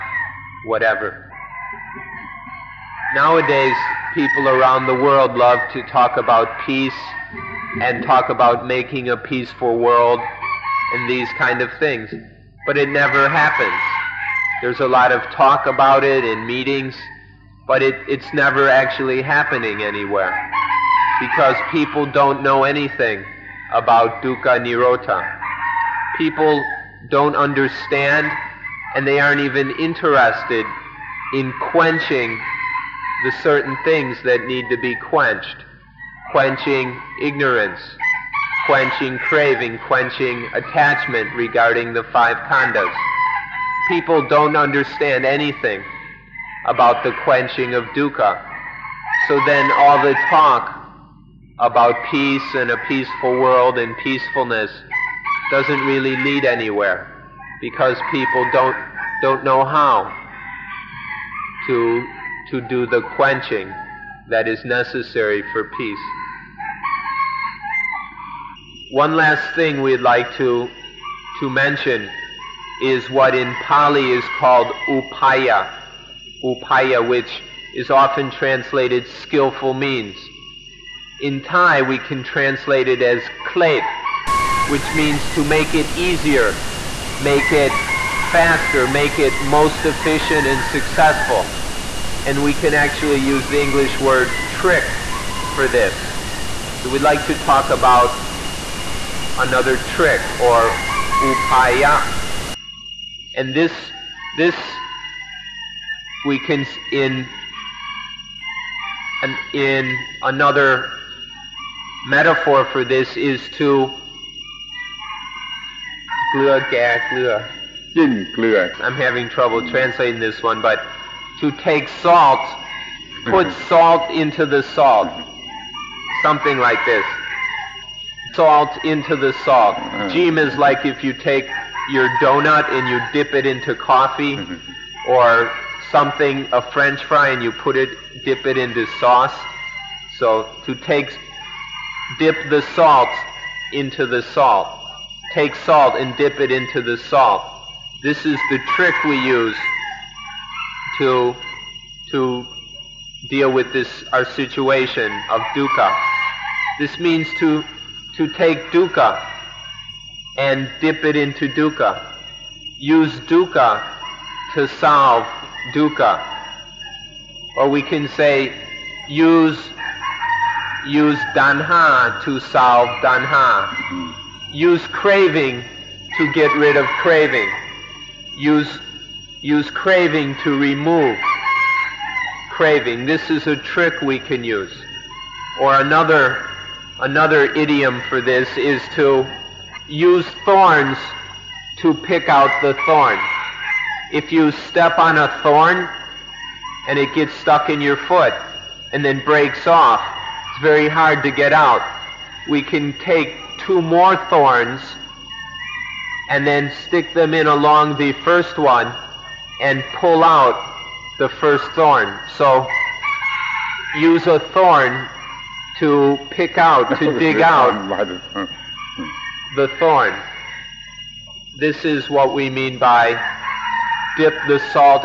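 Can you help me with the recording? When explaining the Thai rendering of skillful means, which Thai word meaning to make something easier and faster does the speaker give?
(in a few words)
klep.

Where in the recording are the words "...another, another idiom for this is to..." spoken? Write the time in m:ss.
3:05.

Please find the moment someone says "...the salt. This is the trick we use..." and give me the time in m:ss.
2:26.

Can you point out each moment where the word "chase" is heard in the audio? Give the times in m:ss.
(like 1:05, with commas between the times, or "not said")
not said.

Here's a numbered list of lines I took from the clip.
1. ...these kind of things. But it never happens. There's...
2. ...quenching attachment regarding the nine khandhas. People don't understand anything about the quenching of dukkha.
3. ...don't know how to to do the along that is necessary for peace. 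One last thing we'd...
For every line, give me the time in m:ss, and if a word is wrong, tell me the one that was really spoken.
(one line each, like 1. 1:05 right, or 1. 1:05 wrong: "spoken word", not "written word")
1. 0:11 right
2. 0:39 wrong: "five", not "nine"
3. 0:59 wrong: "quenching", not "along".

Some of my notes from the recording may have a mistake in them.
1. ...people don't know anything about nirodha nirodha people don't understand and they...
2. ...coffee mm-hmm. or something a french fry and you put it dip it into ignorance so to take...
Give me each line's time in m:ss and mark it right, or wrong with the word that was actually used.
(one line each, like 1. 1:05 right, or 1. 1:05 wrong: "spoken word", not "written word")
1. 0:21 wrong: "dukkha", not "nirodha"
2. 2:13 wrong: "sauce", not "ignorance".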